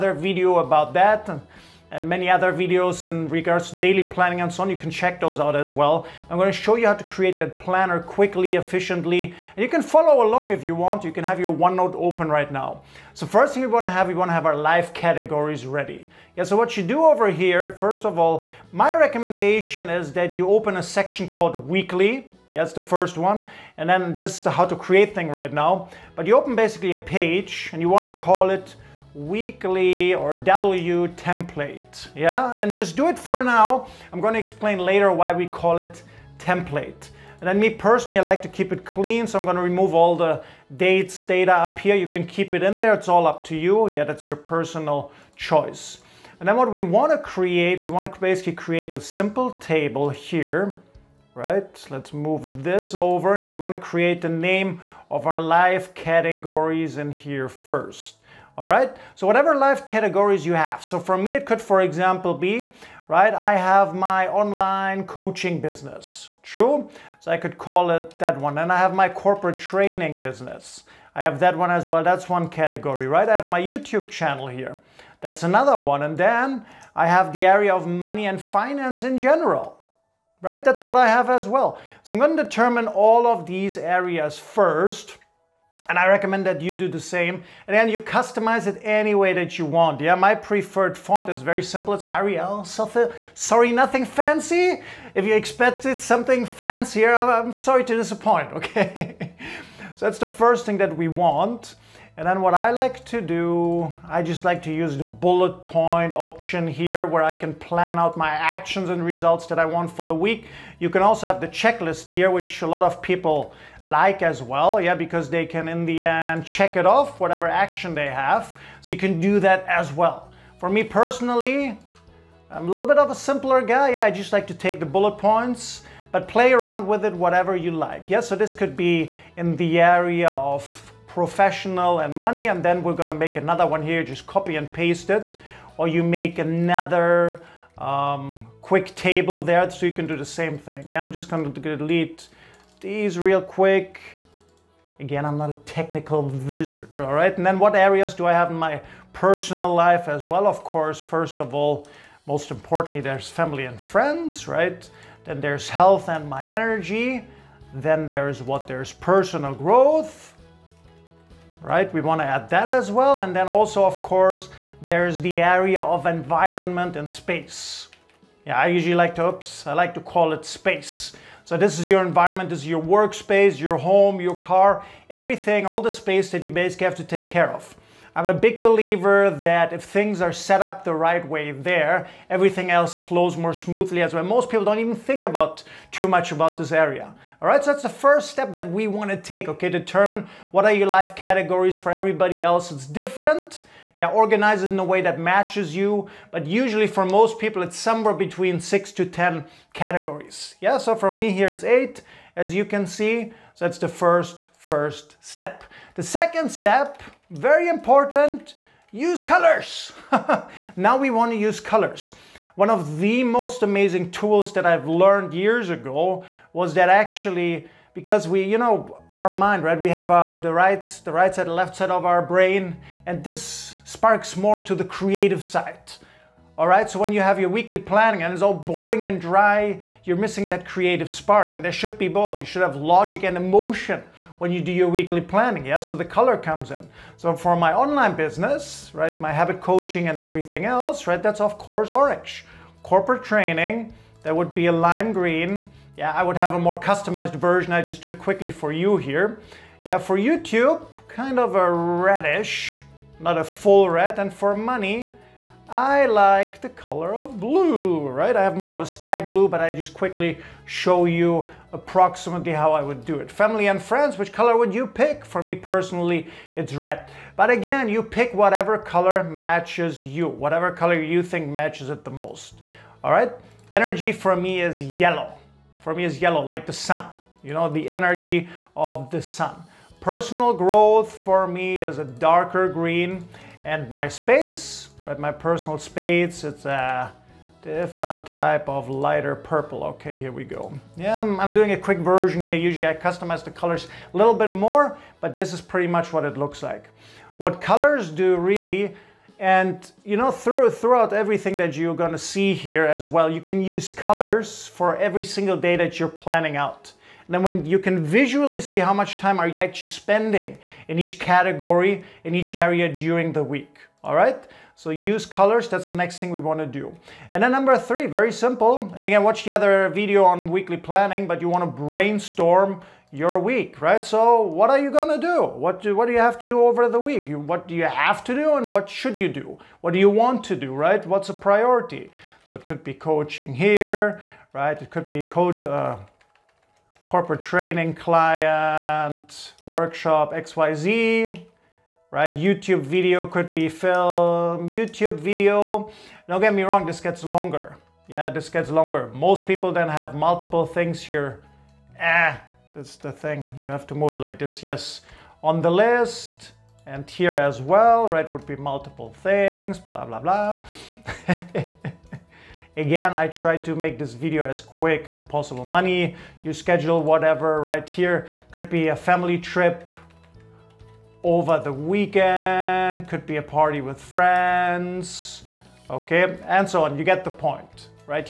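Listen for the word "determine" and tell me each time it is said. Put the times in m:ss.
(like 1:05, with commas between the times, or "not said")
1:22, 3:09.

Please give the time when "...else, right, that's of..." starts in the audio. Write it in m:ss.
4:00.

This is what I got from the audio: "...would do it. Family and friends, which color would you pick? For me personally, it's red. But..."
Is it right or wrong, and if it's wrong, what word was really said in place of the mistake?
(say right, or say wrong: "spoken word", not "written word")
right.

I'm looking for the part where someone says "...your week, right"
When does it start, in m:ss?
5:23.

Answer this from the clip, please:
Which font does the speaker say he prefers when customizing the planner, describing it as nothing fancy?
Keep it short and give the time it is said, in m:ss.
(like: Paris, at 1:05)
Arial, at 1:32.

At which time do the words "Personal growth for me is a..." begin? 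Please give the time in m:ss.
4:39.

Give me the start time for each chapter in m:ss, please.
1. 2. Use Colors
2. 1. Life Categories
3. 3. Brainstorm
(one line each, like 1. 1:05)
1. 3:27
2. 0:13
3. 5:17.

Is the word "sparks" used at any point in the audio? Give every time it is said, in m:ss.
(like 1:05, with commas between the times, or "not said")
3:43, 3:51.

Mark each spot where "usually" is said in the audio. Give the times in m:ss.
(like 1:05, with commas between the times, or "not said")
2:48, 3:16, 4:52.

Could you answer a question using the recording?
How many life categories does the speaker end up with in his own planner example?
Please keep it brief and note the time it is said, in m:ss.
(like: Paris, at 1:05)
8, at 3:21.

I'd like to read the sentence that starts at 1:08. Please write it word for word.
And I have my corporate training business.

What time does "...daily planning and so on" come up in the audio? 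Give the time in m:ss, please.
0:03.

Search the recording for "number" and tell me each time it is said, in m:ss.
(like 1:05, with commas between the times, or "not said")
5:17.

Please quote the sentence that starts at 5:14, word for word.
So use colors, that's the next thing we wanna do.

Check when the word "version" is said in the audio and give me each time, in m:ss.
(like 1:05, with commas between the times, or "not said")
4:07, 4:51.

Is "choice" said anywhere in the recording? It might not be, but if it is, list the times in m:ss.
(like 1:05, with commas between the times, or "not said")
0:45.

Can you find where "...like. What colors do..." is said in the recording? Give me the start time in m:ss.
4:56.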